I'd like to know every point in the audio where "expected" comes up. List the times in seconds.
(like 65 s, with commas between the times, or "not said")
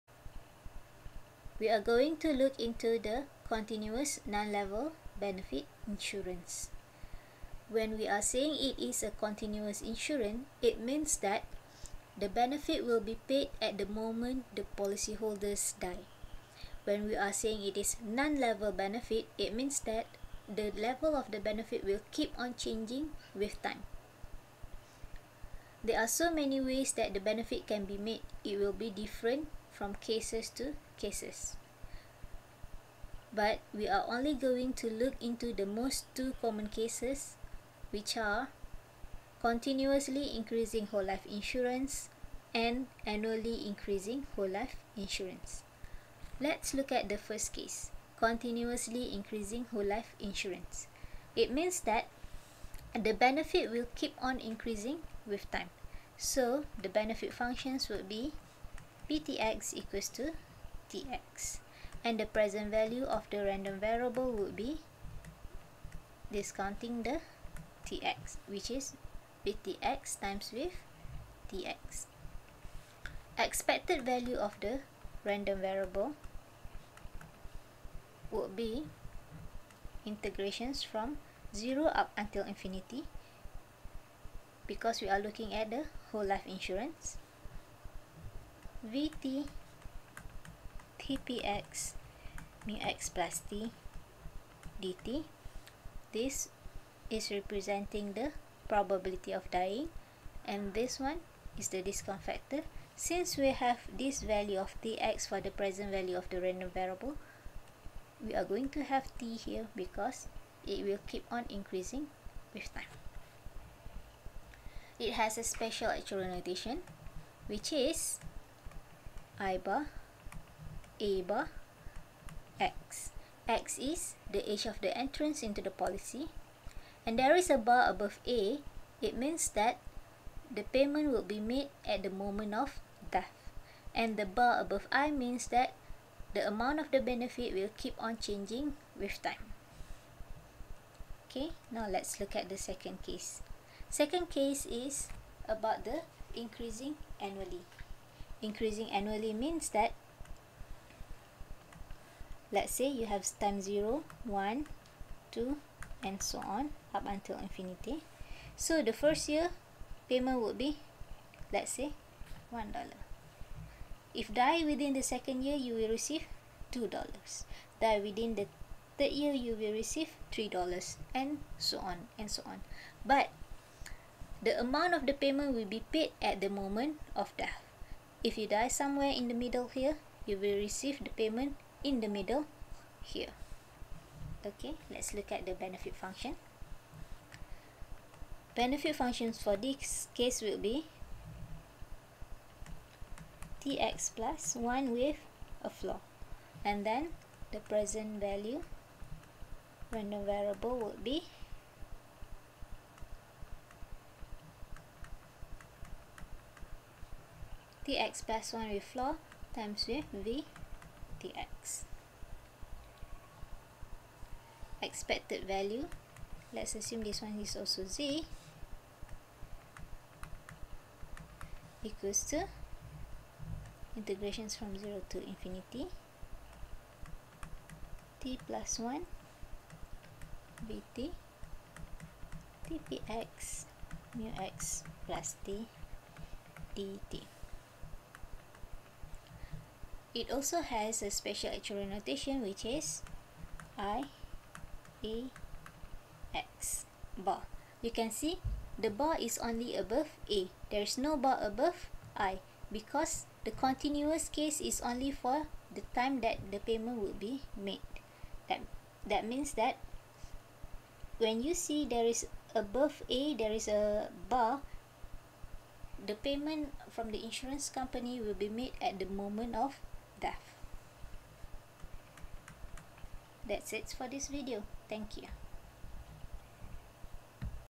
73 s, 214 s.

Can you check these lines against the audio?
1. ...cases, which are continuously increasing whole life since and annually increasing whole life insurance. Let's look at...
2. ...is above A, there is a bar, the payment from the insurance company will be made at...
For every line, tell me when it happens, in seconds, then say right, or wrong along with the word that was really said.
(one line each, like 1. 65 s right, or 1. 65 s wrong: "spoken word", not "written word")
1. 36 s wrong: "insurance", not "since"
2. 262 s right.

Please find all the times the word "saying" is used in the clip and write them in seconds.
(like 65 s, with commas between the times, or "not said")
8 s, 17 s.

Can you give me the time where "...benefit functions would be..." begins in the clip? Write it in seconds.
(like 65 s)
56 s.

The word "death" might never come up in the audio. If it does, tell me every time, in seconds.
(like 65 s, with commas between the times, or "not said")
133 s, 177 s, 270 s.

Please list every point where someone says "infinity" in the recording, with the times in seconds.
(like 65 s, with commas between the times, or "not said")
82 s, 157 s, 225 s.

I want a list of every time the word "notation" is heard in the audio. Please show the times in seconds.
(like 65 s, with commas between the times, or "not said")
116 s, 241 s.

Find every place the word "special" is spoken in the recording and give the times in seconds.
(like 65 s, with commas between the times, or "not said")
115 s, 241 s.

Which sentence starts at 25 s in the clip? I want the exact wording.
There are so many ways that the benefit can be made.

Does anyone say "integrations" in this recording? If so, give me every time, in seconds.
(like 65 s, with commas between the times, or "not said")
80 s, 223 s.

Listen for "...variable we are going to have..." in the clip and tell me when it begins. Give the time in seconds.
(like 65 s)
106 s.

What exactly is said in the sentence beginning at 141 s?
Okay, now let's look at the second case.